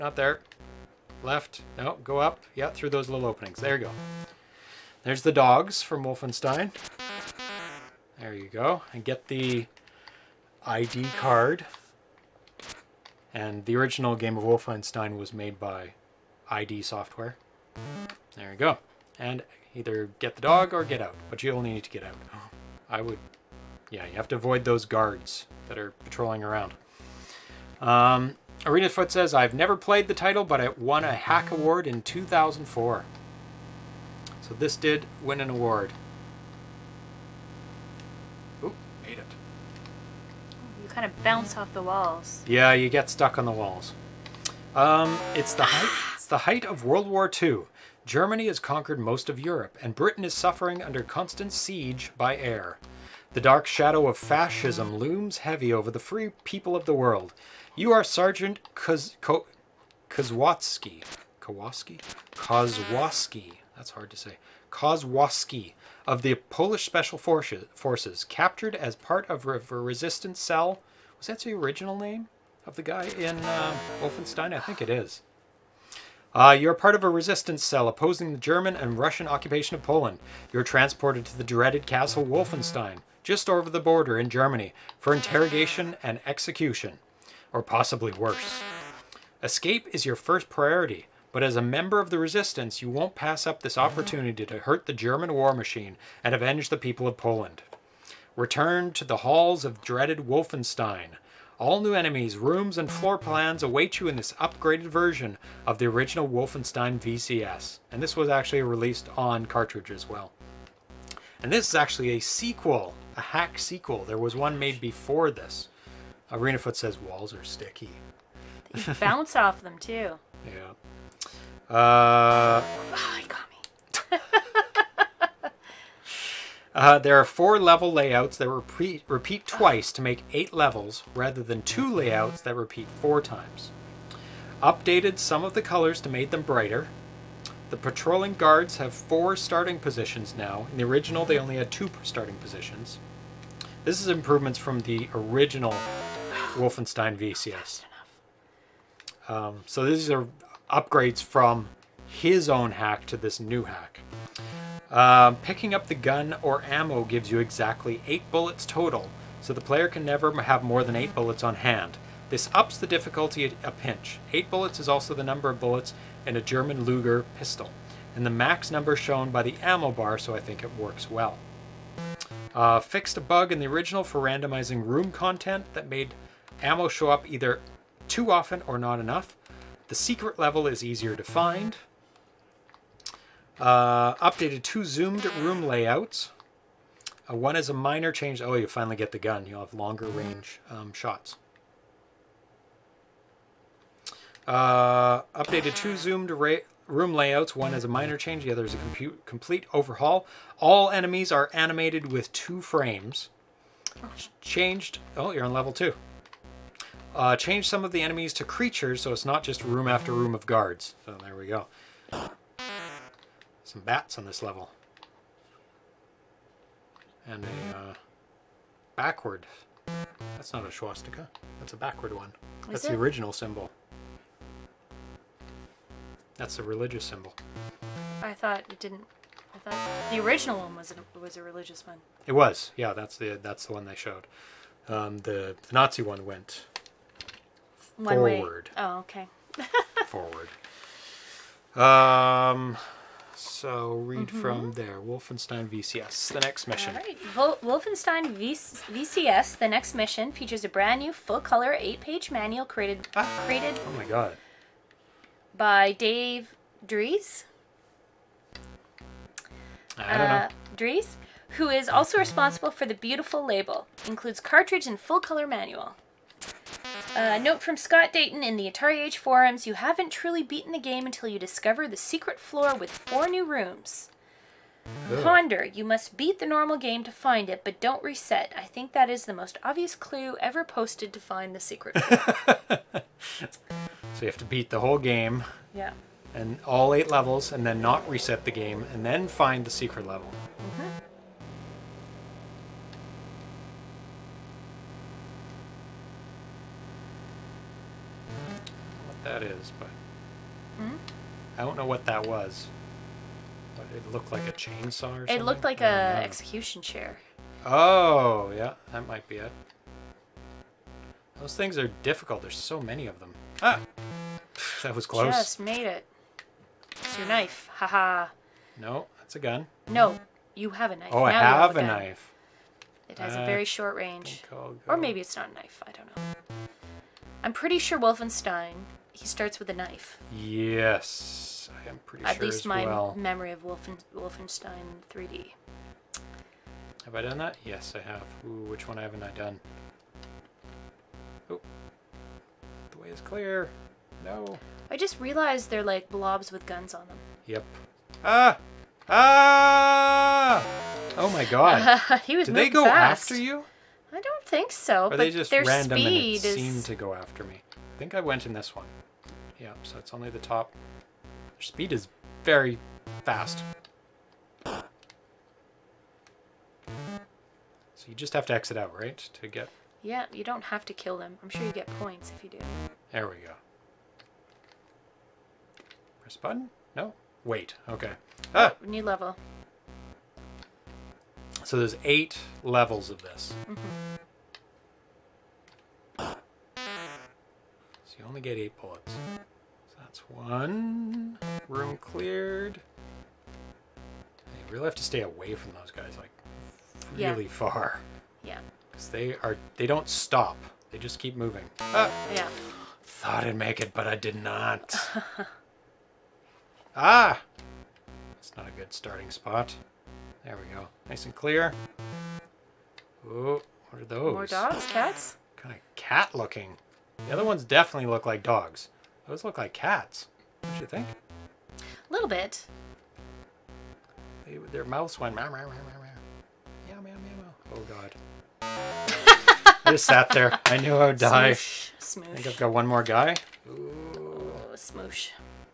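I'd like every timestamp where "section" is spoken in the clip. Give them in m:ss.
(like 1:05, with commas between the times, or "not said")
not said.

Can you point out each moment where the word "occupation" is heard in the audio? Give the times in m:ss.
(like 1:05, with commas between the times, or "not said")
1:19.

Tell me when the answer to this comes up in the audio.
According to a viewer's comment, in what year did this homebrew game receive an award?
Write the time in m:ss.
0:32.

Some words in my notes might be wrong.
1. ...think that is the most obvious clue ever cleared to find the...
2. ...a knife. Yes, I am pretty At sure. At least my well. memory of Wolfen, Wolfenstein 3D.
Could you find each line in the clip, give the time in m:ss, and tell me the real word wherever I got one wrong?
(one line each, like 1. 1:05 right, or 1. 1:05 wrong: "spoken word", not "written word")
1. 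4:38 wrong: "posted", not "cleared"
2. 5:29 right.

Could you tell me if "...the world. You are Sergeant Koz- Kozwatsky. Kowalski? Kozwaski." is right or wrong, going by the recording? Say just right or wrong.
right.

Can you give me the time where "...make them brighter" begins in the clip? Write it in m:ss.
2:16.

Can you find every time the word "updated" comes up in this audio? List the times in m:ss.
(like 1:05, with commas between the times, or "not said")
2:14, 3:04, 3:15.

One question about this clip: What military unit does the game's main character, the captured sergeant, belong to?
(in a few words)
Polish Special Forces.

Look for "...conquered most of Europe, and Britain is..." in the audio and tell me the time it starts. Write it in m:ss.
0:48.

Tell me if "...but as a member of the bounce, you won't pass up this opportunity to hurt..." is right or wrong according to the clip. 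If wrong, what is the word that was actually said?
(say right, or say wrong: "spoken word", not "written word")
wrong: "resistance", not "bounce".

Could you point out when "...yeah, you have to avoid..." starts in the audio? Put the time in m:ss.
0:23.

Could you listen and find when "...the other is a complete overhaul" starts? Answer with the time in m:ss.
3:18.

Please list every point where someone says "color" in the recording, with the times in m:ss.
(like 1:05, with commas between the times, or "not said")
2:15, 4:11, 4:25.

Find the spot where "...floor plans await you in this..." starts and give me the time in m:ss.
1:42.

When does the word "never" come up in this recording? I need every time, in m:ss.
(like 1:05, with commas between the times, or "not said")
0:29, 2:40.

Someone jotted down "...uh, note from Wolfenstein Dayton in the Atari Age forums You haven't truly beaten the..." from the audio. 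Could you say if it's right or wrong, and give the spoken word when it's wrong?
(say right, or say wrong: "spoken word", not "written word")
wrong: "Scott", not "Wolfenstein".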